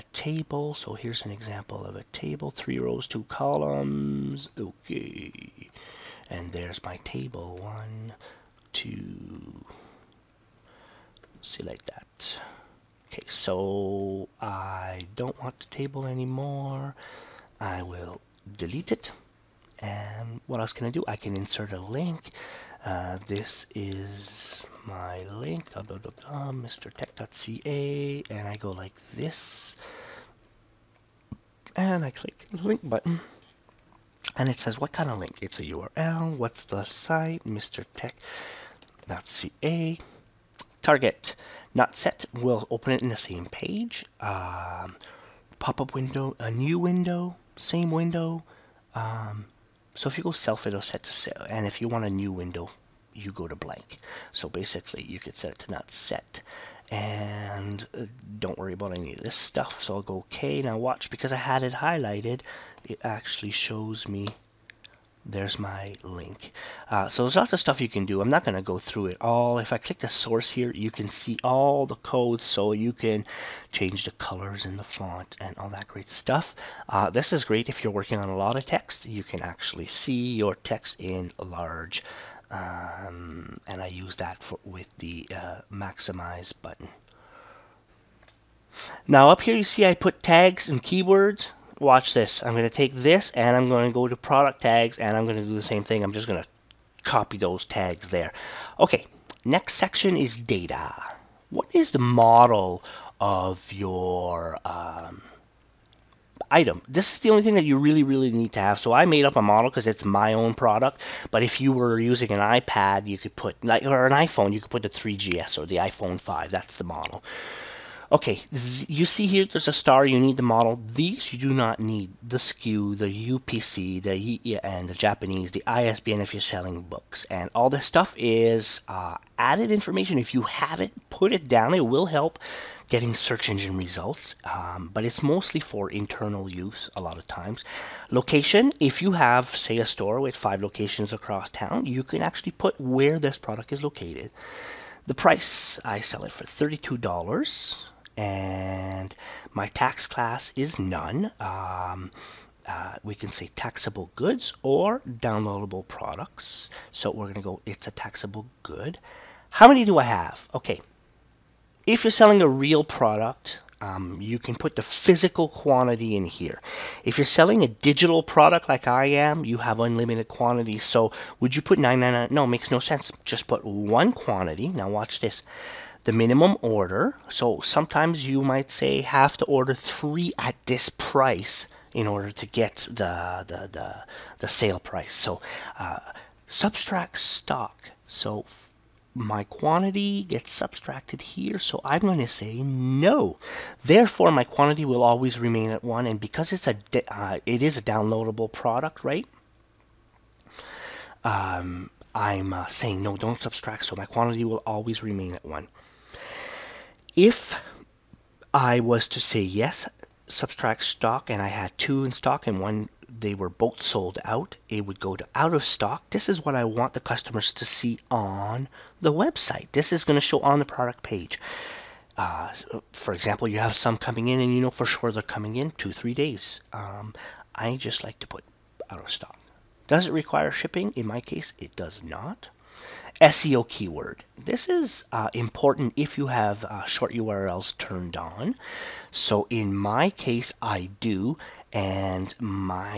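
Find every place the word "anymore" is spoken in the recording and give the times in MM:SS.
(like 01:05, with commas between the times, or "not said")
00:16.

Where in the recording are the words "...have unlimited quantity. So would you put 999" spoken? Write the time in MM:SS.
02:49.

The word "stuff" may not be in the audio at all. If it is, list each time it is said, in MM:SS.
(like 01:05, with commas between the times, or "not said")
00:59, 01:07, 01:16, 02:07.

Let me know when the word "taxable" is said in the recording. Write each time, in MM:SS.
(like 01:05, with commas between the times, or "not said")
02:33, 02:37.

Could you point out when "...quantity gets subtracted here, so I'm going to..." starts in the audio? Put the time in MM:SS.
03:09.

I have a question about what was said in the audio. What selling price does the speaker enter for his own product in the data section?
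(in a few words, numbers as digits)
$32.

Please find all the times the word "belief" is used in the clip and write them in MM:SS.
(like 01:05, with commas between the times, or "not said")
not said.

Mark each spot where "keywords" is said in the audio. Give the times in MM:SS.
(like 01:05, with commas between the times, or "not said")
01:30, 03:53.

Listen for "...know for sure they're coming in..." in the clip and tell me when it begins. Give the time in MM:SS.
03:44.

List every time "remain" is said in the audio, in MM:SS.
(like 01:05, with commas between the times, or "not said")
03:15, 03:25.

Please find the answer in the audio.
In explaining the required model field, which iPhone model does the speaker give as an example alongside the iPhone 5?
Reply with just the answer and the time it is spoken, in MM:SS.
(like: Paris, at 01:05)
3GS, at 01:54.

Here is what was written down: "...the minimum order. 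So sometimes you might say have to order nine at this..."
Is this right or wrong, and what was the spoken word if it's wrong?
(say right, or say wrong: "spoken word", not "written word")
wrong: "three", not "nine".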